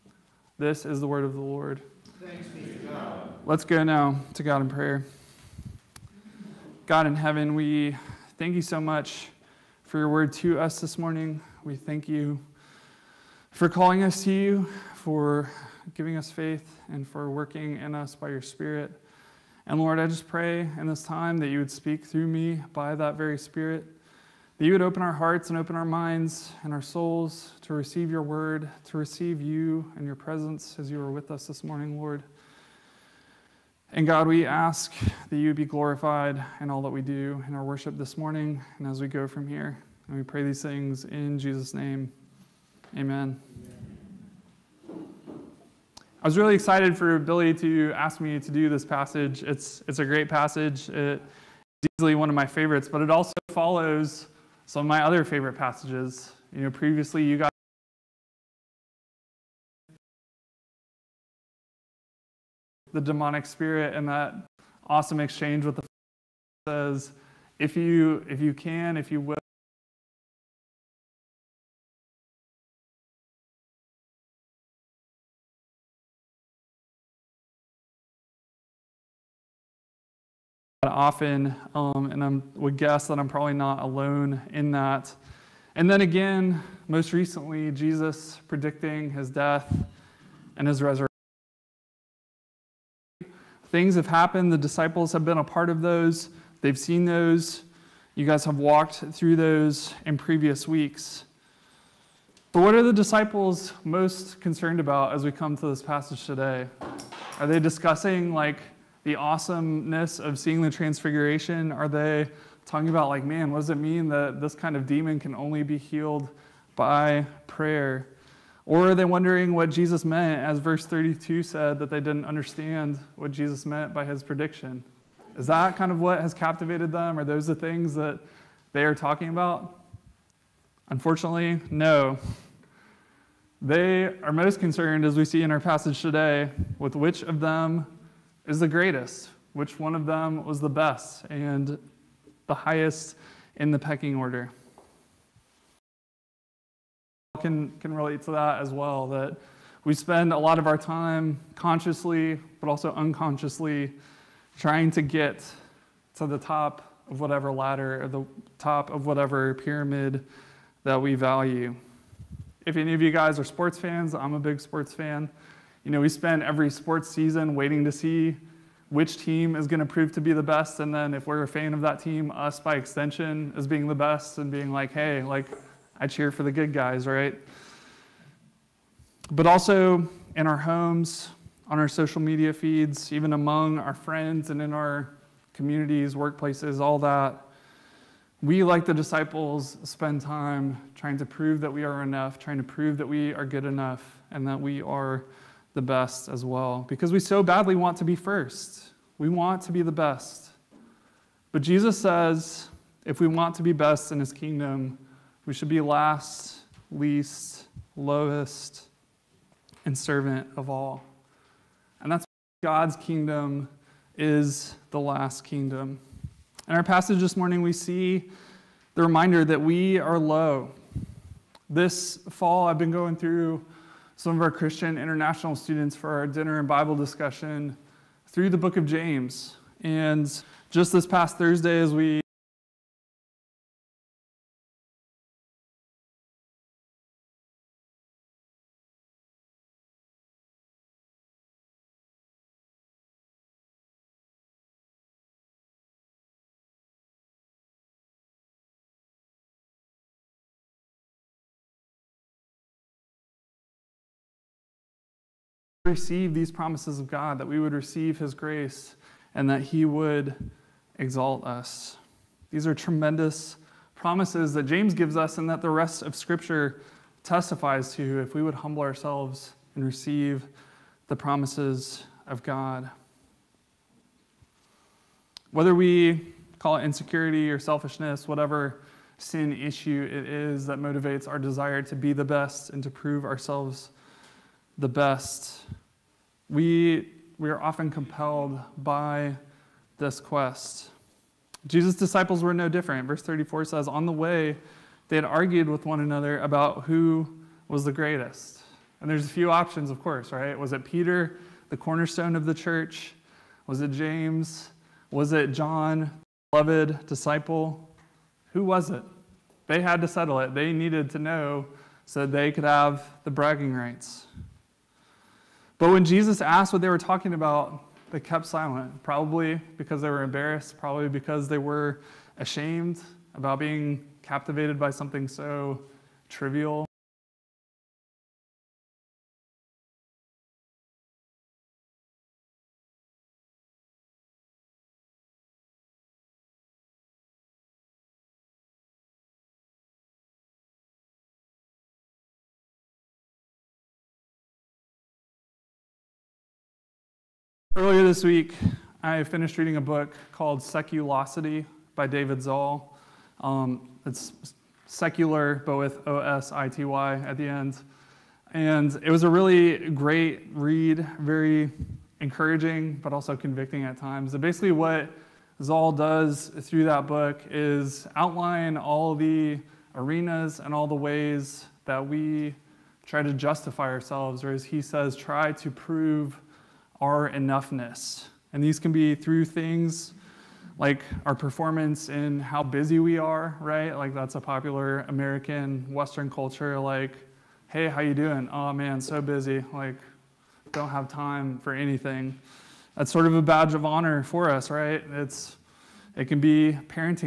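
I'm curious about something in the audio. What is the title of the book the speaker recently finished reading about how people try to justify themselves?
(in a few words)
Seculosity.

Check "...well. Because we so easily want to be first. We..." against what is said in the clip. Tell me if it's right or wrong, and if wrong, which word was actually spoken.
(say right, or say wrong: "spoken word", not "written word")
wrong: "badly", not "easily".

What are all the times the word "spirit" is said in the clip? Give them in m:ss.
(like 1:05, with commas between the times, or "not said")
0:18, 0:23, 1:03.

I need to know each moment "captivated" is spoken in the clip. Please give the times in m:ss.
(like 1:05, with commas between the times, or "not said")
2:06, 5:24.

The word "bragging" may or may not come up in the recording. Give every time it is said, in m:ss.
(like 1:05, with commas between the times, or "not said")
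5:13.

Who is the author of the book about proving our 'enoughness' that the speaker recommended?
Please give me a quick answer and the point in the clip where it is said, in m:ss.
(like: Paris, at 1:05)
David Zahl, at 5:52.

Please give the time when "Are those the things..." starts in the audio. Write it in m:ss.
2:07.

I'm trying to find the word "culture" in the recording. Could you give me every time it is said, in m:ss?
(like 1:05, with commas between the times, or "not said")
6:26.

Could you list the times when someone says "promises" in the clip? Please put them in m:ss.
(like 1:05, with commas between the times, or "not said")
4:16, 4:23, 4:31.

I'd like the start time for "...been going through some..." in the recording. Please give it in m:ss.
3:42.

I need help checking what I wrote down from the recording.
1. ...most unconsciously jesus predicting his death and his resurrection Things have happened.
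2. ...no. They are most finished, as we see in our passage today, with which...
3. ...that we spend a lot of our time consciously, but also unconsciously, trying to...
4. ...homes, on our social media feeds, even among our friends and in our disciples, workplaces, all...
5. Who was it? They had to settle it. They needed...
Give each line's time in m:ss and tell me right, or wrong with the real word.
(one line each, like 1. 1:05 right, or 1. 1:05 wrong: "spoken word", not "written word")
1. 1:26 wrong: "recently", not "unconsciously"
2. 2:11 wrong: "concerned", not "finished"
3. 2:29 right
4. 3:00 wrong: "communities", not "disciples"
5. 5:08 right.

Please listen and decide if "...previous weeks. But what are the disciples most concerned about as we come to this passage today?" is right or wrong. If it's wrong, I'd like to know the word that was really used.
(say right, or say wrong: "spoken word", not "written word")
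right.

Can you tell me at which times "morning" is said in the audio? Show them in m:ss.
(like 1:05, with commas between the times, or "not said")
0:10, 0:31, 0:38, 3:37.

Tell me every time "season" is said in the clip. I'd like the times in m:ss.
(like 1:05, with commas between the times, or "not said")
2:47.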